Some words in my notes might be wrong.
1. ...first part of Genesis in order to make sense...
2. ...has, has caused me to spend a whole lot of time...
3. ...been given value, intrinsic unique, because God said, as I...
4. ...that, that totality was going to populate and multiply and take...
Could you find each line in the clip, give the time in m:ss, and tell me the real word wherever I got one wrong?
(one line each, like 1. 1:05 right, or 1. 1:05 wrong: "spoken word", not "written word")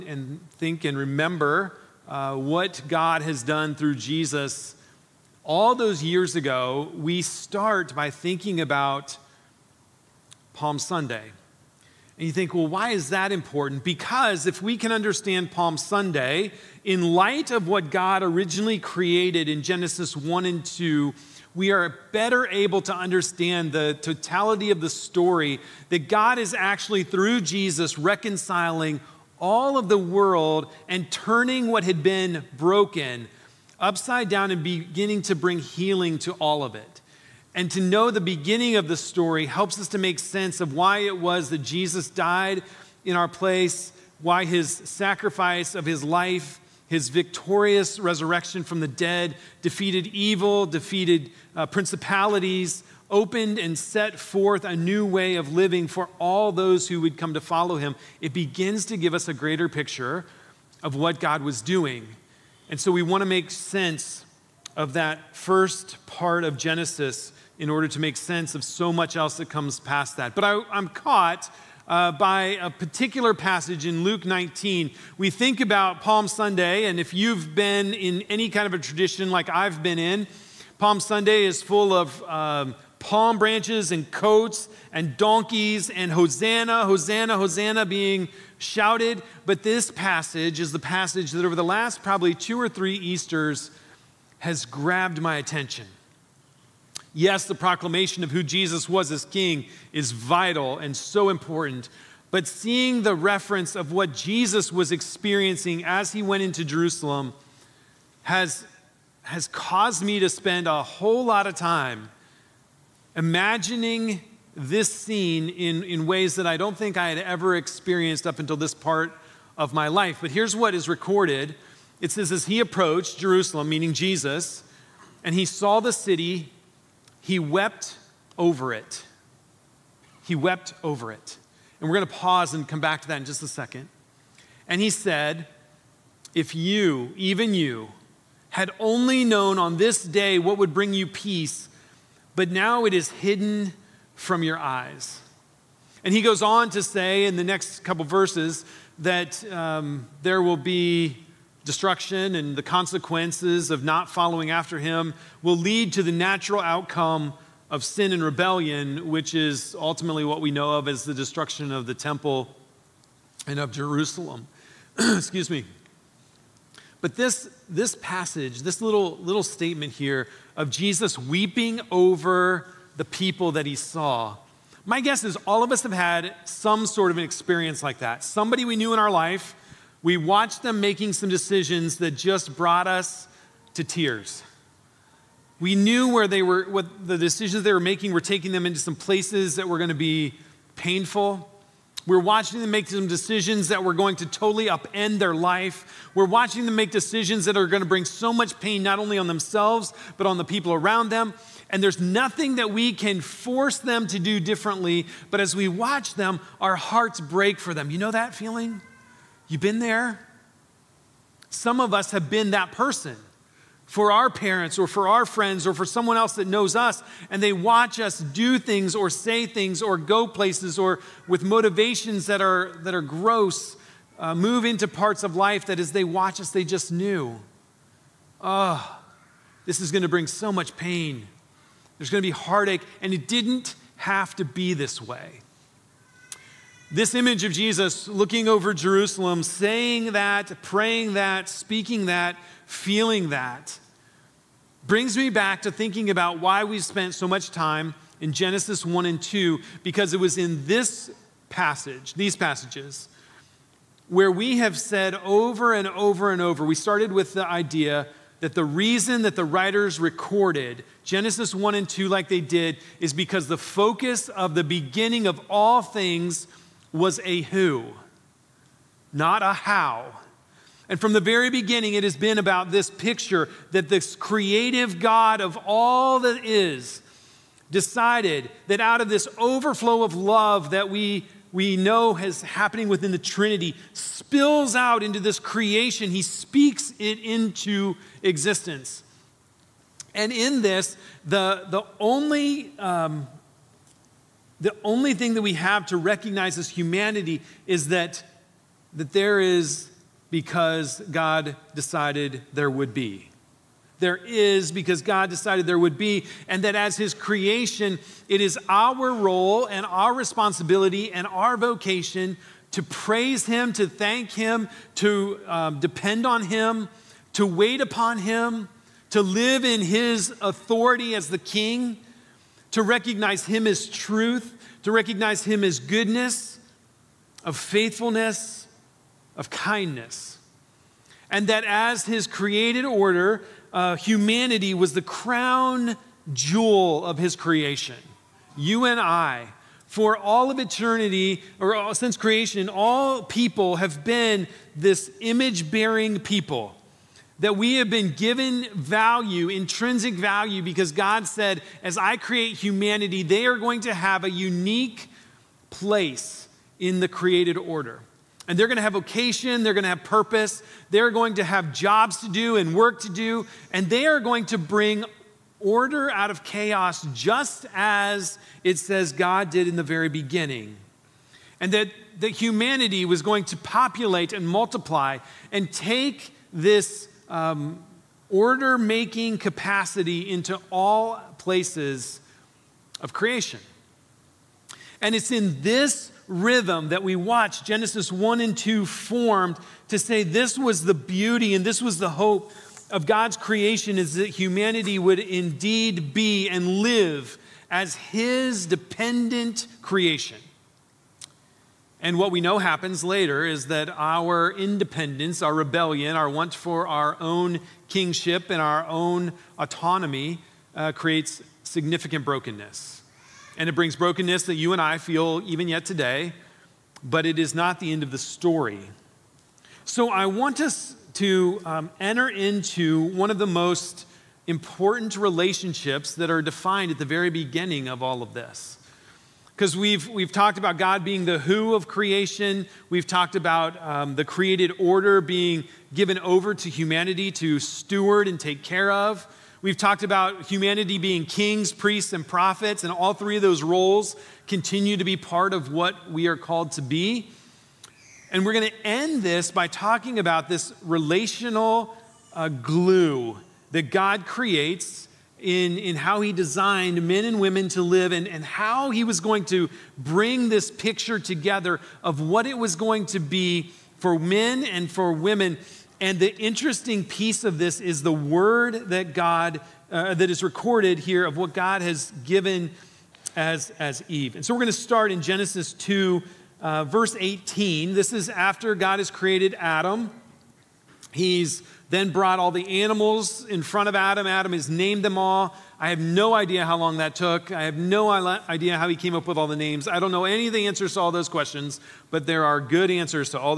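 1. 1:05 right
2. 1:48 right
3. 5:47 wrong: "value", not "unique"
4. 6:11 wrong: "humanity", not "totality".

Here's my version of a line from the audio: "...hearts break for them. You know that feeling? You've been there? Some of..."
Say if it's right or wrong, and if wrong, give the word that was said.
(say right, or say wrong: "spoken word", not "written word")
right.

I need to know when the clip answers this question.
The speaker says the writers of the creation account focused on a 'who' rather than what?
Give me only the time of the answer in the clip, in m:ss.
4:29.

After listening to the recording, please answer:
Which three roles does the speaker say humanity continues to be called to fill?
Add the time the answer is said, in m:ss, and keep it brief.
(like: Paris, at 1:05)
Kings, priests, and prophets, at 7:21.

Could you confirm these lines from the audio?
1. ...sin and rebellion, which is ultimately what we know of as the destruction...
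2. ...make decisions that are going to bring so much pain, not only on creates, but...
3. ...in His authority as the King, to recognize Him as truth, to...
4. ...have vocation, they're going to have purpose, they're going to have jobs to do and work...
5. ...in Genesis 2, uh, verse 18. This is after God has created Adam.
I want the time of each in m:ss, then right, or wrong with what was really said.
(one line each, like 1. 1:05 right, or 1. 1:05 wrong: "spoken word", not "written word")
1. 2:37 right
2. 3:16 wrong: "themselves", not "creates"
3. 5:19 right
4. 5:58 right
5. 7:55 right.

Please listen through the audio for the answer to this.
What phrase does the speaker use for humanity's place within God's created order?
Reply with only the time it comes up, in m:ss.
5:35.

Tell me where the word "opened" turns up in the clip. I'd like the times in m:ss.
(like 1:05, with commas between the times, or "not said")
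0:53.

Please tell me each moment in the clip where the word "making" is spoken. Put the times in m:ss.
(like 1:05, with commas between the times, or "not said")
3:00, 3:07, 6:18.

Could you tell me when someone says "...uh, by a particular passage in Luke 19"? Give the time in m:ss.
1:11.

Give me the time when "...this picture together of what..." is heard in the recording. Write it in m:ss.
7:40.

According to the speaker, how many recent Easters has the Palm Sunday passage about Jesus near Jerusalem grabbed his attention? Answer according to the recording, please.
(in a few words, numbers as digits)
2 or 3.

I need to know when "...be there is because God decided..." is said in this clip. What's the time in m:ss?
5:02.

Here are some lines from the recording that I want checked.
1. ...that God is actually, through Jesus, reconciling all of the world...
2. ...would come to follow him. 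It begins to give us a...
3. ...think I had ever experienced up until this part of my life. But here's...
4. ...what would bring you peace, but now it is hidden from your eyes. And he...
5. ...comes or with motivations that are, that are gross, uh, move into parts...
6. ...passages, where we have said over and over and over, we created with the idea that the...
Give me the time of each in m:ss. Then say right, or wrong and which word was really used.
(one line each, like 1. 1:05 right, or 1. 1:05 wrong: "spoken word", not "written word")
1. 0:25 right
2. 0:57 right
3. 1:56 right
4. 2:20 right
5. 3:40 wrong: "places", not "comes"
6. 4:12 wrong: "started", not "created".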